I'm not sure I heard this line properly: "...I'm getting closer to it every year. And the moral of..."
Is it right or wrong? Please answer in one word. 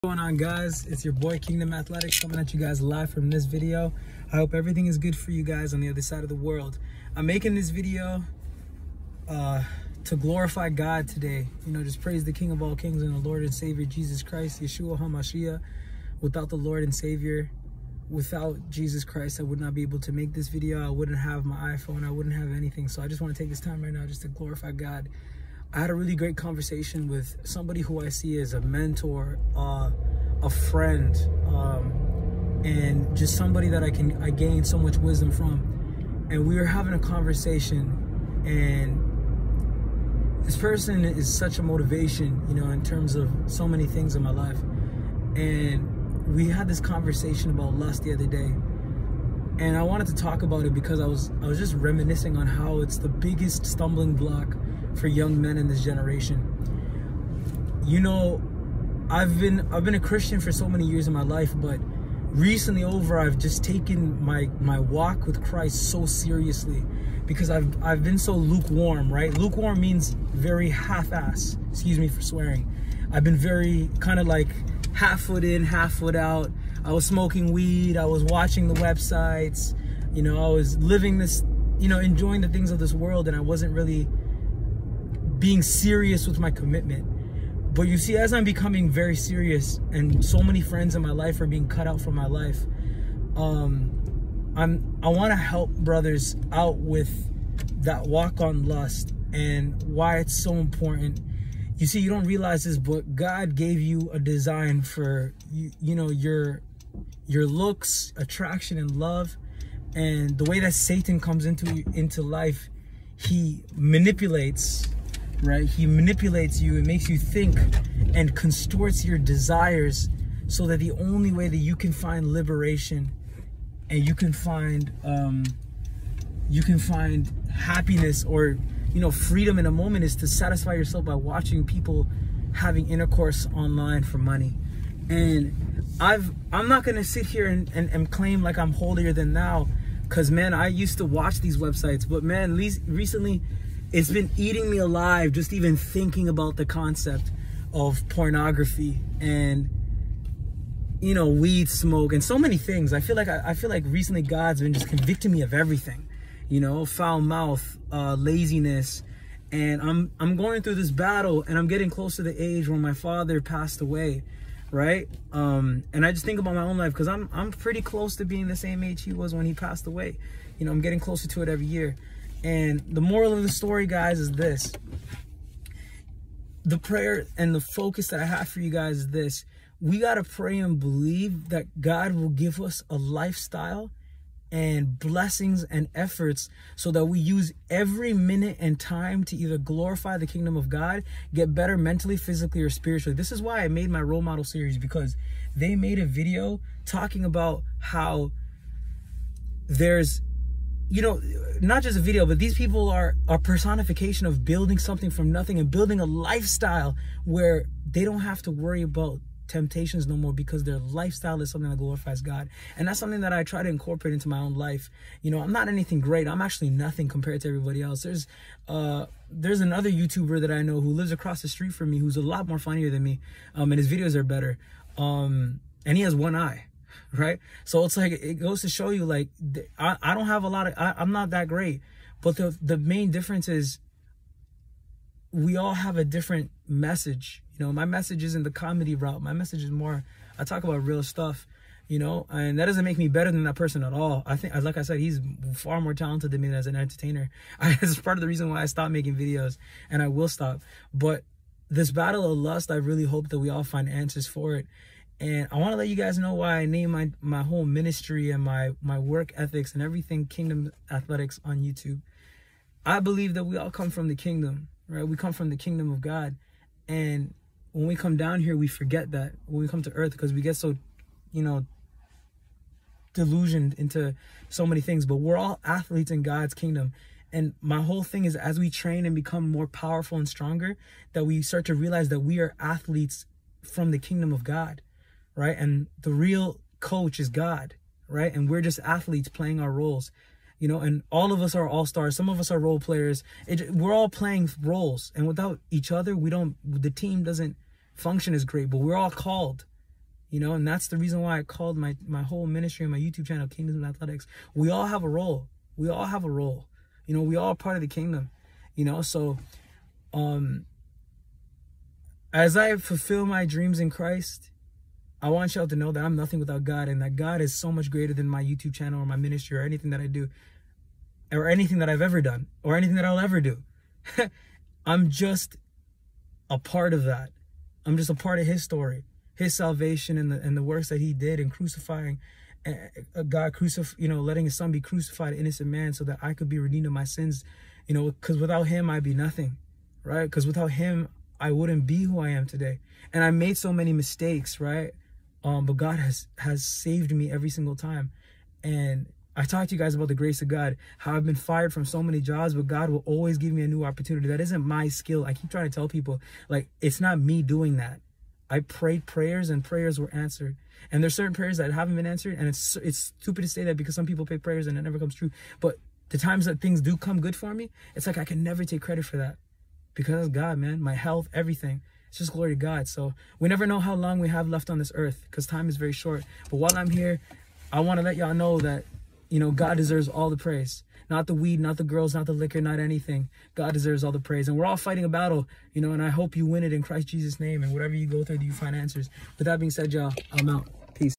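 right.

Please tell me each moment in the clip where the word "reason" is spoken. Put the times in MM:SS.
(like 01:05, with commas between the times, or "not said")
04:08, 05:00.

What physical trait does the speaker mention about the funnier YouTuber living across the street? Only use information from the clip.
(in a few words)
one eye.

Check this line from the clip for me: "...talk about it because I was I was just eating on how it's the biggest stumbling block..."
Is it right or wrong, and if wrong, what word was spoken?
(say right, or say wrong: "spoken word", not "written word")
wrong: "reminiscing", not "eating".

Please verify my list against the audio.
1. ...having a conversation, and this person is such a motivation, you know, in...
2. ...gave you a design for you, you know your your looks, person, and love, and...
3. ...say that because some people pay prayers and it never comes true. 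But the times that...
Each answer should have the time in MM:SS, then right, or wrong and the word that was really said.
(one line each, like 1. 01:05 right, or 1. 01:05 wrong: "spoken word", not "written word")
1. 00:36 right
2. 01:43 wrong: "attraction", not "person"
3. 06:03 right.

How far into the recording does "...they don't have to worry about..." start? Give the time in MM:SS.
03:27.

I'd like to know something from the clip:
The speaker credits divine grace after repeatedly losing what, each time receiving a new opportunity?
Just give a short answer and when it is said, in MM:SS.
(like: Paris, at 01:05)
jobs, at 05:51.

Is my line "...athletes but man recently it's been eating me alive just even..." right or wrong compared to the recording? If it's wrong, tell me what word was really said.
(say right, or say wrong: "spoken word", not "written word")
wrong: "websites", not "athletes".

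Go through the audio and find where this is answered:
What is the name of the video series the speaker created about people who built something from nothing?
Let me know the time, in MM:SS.
03:14.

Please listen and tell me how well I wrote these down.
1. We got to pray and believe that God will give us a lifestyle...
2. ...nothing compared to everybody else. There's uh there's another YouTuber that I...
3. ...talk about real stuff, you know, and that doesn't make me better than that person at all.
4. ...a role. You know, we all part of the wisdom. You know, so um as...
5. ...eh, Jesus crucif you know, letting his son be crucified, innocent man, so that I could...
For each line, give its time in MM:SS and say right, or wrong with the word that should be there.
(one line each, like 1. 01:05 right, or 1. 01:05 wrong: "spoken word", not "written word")
1. 02:59 right
2. 03:36 right
3. 04:00 right
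4. 05:06 wrong: "kingdom", not "wisdom"
5. 05:33 wrong: "God", not "Jesus".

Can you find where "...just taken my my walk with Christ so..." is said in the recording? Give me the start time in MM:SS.
01:03.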